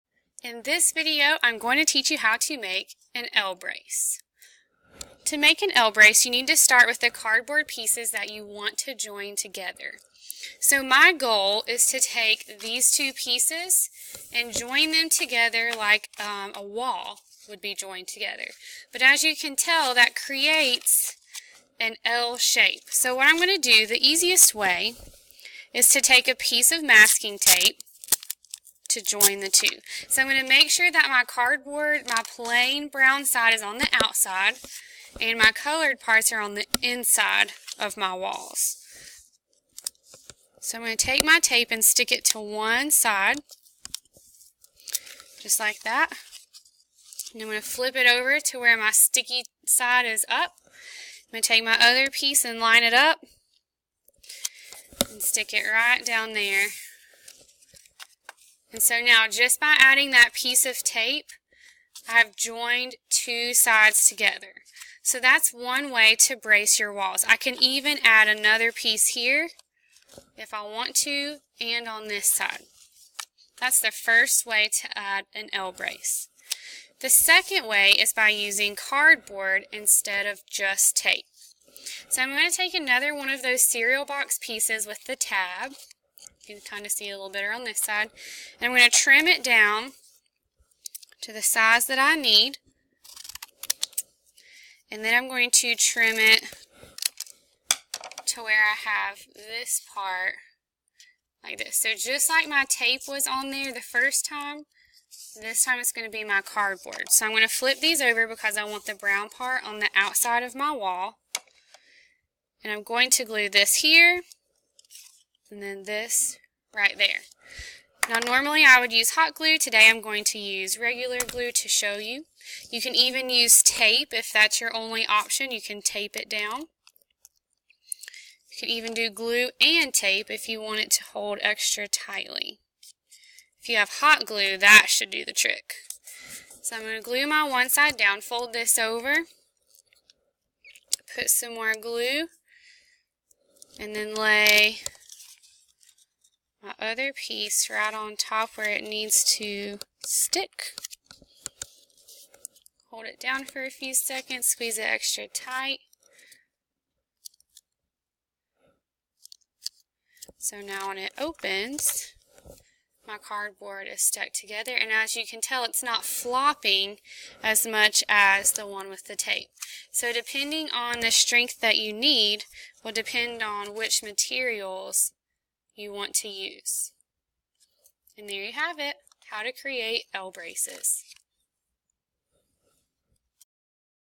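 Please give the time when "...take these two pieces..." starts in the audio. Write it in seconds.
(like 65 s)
11 s.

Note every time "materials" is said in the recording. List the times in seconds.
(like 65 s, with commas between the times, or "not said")
174 s.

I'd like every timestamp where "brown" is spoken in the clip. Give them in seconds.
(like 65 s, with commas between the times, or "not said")
32 s, 108 s.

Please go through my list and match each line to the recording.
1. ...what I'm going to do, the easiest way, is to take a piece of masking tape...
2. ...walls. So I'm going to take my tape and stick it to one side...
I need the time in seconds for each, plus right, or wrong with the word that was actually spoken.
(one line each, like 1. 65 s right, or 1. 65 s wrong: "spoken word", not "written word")
1. 23 s right
2. 38 s right.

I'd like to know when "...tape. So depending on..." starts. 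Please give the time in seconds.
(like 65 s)
169 s.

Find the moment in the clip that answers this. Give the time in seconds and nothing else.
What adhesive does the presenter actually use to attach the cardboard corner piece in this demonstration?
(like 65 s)
120 s.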